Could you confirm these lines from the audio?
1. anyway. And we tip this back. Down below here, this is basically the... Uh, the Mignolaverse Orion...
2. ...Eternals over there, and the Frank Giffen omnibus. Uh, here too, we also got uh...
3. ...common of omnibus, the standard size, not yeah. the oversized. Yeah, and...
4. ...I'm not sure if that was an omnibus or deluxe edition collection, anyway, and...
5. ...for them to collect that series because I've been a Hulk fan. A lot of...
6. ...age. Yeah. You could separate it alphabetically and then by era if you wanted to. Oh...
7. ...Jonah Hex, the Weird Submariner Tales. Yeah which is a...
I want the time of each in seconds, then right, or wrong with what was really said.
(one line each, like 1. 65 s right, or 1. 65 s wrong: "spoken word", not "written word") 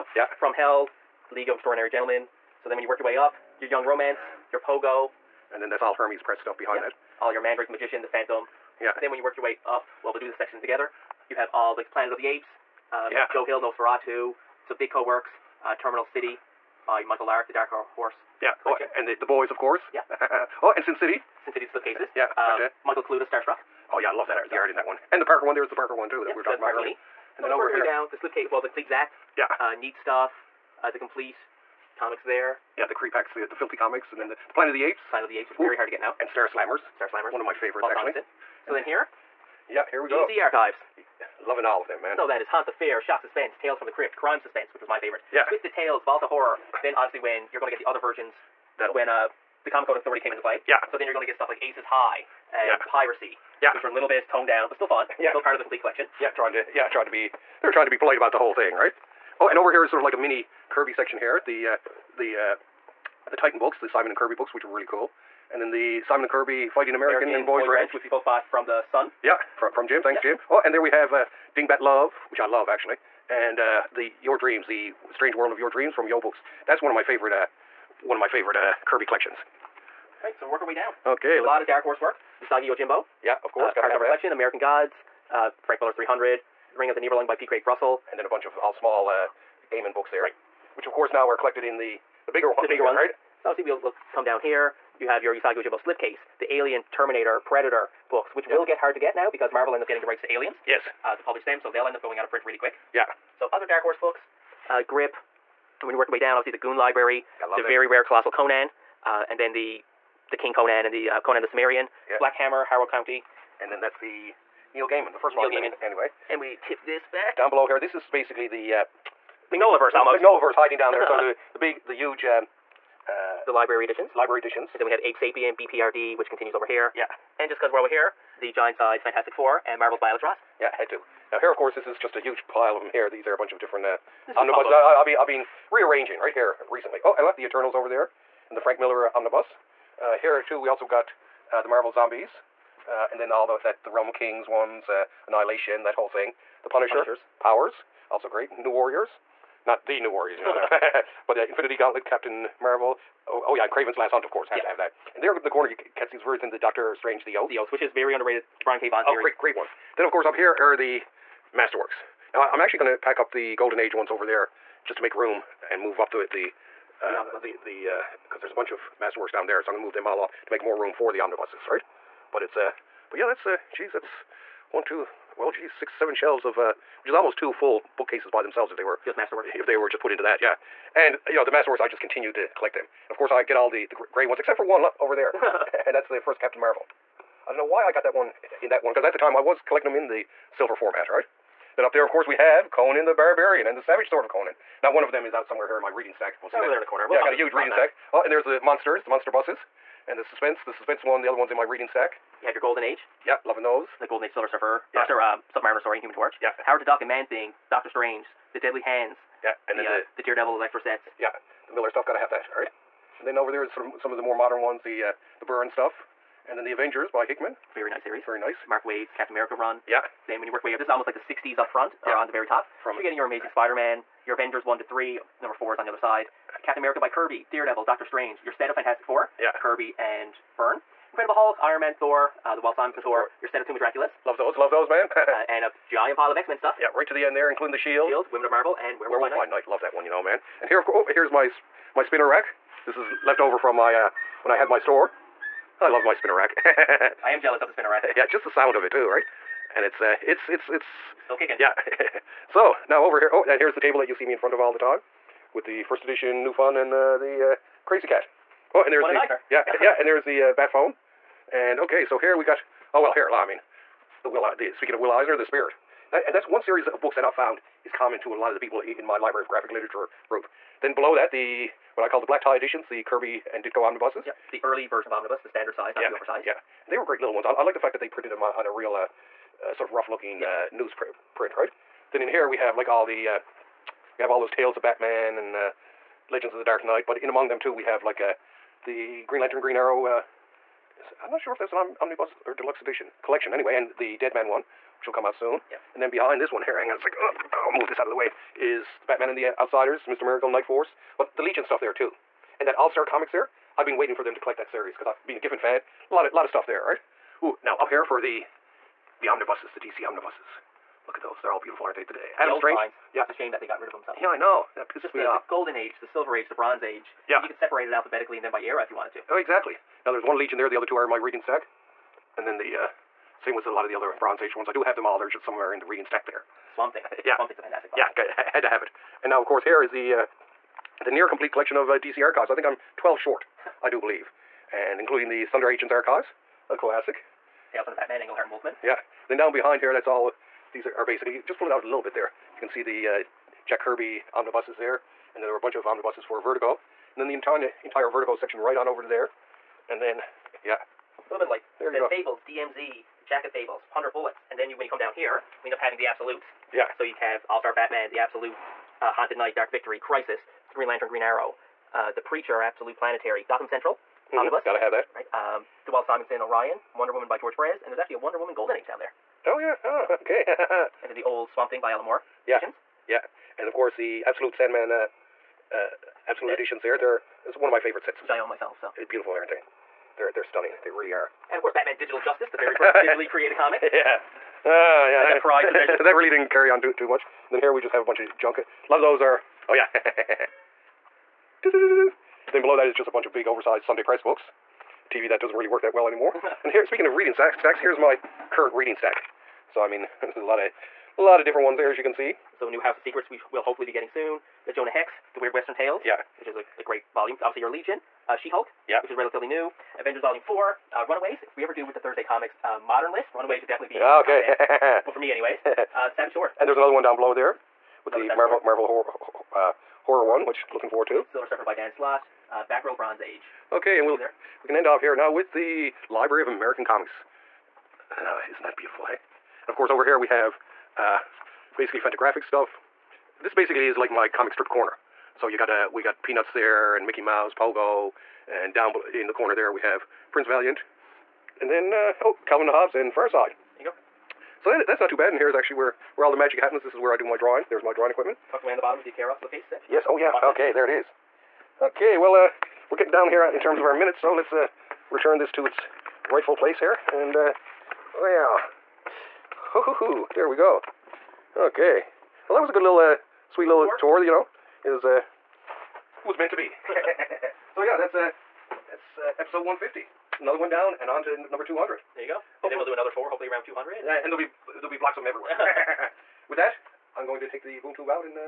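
1. 115 s wrong: "Magn", not "Orion"
2. 137 s wrong: "Miller", not "Giffen"
3. 274 s wrong: "version", not "common"
4. 291 s right
5. 304 s wrong: "Giffen", not "Hulk"
6. 316 s right
7. 404 s wrong: "Western", not "Submariner".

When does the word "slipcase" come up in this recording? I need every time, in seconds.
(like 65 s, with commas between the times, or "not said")
21 s, 28 s, 95 s, 449 s.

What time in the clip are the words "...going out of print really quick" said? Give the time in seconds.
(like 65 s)
102 s.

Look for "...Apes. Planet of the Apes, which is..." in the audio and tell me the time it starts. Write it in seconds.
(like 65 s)
34 s.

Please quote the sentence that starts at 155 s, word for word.
And there in the corner, you can Ketsey's Verth and the Doctor Strange, The Oath.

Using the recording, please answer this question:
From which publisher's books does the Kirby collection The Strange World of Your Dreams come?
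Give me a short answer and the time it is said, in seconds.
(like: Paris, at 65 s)
Yoe Books, at 76 s.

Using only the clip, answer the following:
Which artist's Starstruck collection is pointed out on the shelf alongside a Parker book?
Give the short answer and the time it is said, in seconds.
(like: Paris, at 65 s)
Michael Kaluta, at 22 s.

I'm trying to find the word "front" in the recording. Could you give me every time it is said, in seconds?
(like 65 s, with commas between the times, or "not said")
221 s, 254 s.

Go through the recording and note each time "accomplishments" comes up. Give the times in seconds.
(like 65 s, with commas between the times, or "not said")
not said.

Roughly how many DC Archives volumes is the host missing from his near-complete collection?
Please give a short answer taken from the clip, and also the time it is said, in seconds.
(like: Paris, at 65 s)
12, at 332 s.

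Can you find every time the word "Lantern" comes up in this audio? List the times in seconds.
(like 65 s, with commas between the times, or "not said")
289 s, 360 s.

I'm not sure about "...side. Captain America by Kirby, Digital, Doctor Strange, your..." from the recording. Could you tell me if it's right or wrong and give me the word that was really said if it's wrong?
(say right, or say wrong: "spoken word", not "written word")
wrong: "Daredevil", not "Digital".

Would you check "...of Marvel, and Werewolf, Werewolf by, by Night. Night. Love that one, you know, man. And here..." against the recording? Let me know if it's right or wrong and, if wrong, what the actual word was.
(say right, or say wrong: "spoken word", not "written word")
right.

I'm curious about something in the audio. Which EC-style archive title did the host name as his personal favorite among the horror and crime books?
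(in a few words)
Crime Suspense.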